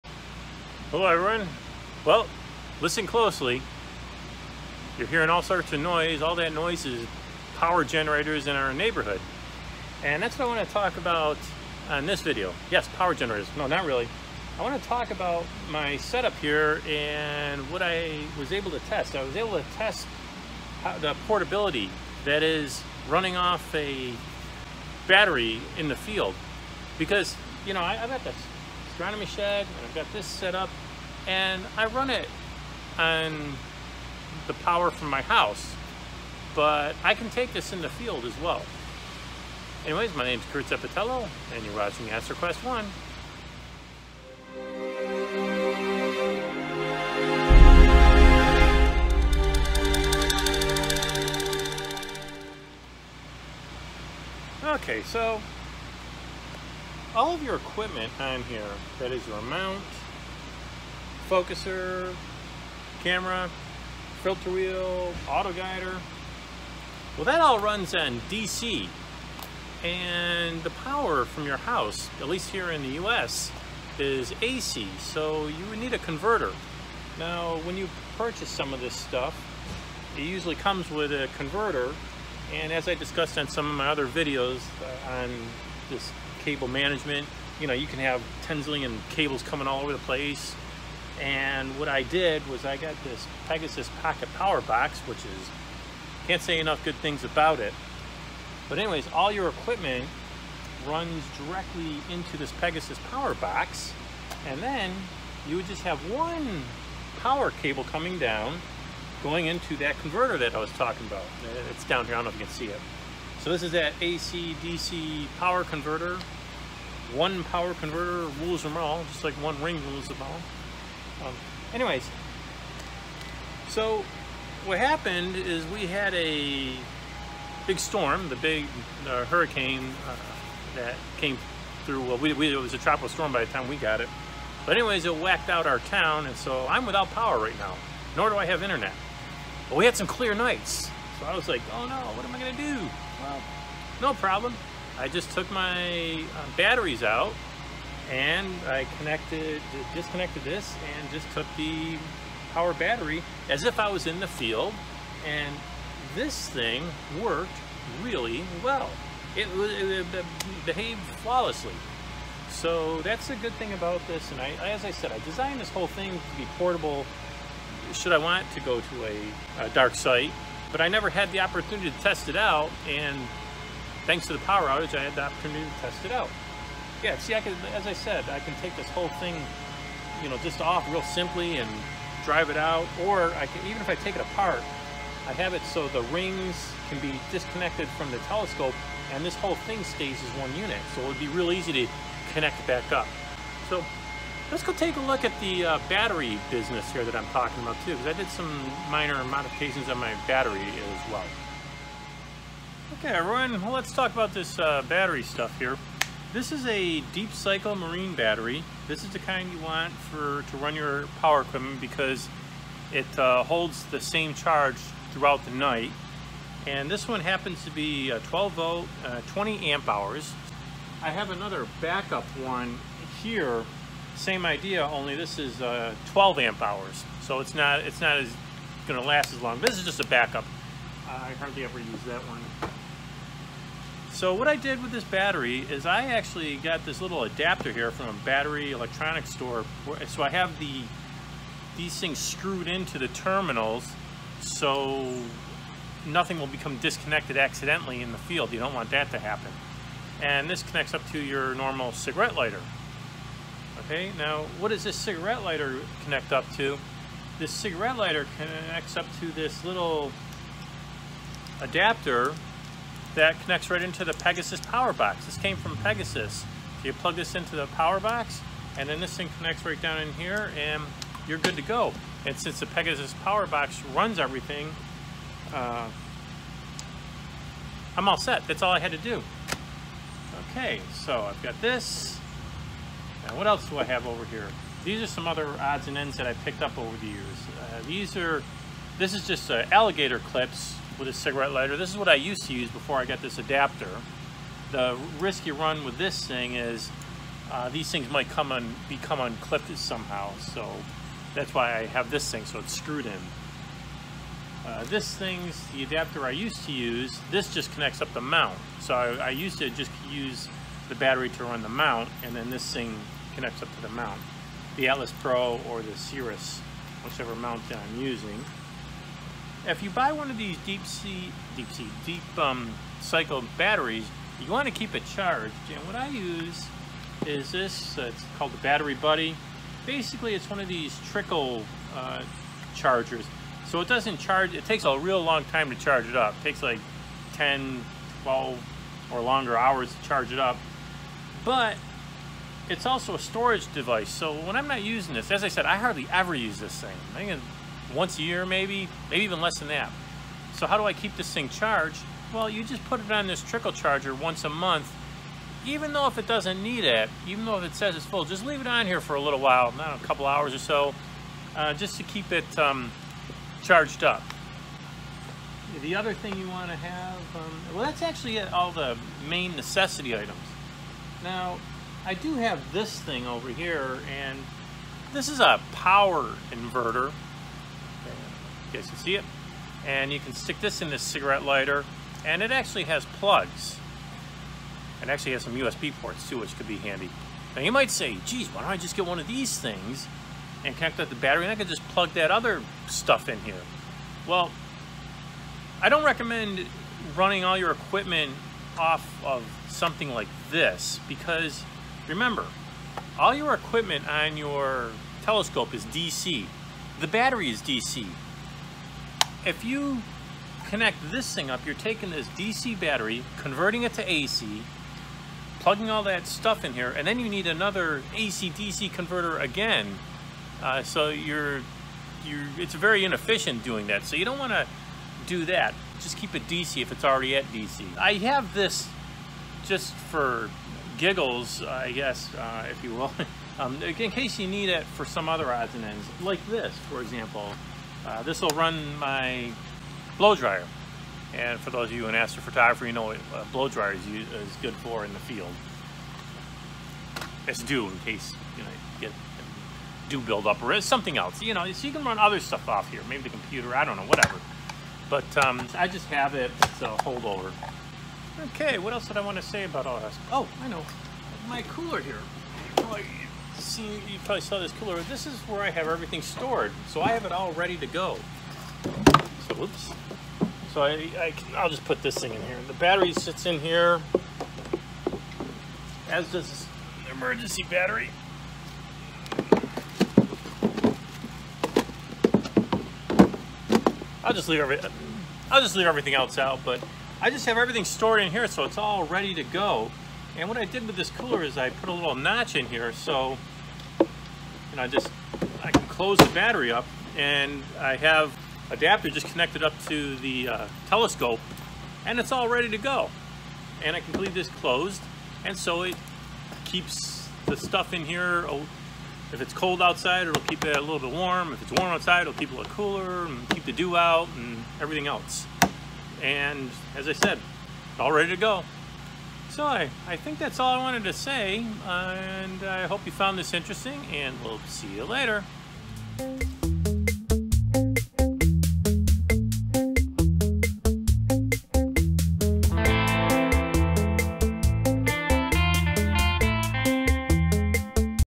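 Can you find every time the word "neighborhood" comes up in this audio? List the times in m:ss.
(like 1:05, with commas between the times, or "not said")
0:08.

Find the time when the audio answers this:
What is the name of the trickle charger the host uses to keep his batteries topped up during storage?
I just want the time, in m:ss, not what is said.
5:28.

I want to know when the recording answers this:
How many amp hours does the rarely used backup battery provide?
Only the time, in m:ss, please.
3:46.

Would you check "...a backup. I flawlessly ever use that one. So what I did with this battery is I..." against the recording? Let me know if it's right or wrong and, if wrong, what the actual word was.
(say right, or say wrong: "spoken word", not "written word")
wrong: "hardly", not "flawlessly".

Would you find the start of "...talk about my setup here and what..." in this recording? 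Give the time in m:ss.
0:14.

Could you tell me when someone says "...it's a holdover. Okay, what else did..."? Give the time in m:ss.
7:36.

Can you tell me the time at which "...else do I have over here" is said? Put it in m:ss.
4:43.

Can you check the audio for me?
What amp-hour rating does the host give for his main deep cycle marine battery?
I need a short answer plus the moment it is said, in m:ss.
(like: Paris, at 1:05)
20 amp hours, at 3:39.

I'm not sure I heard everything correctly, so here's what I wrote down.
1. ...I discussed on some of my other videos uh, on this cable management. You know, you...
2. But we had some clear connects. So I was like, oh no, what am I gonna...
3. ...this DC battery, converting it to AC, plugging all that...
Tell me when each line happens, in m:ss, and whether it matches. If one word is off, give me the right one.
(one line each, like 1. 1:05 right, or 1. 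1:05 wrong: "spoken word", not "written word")
1. 1:22 right
2. 2:19 wrong: "nights", not "connects"
3. 6:52 right.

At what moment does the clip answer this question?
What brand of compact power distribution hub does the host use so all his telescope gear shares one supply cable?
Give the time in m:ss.
1:33.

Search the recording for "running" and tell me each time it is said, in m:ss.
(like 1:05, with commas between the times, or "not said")
0:23, 6:37.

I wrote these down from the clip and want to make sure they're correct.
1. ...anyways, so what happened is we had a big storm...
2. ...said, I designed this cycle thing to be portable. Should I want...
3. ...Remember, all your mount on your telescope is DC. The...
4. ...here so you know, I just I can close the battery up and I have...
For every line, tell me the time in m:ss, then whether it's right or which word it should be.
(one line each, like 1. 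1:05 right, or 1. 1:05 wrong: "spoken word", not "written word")
1. 2:01 right
2. 2:44 wrong: "whole", not "cycle"
3. 6:42 wrong: "equipment", not "mount"
4. 8:12 right.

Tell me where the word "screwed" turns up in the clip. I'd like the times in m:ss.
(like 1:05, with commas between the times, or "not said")
4:02, 5:02.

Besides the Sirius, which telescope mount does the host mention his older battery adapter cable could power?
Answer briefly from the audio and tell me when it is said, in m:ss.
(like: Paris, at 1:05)
Atlas Pro, at 5:14.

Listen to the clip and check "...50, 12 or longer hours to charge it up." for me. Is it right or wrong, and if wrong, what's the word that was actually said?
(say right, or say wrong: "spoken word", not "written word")
wrong: "10", not "50".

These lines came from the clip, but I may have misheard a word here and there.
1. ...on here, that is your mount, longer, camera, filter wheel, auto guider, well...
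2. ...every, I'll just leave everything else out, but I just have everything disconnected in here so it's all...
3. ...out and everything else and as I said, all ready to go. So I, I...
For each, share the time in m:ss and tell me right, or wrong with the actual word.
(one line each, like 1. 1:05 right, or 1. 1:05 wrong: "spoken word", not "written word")
1. 0:58 wrong: "focuser", not "longer"
2. 8:04 wrong: "stored", not "disconnected"
3. 8:33 right.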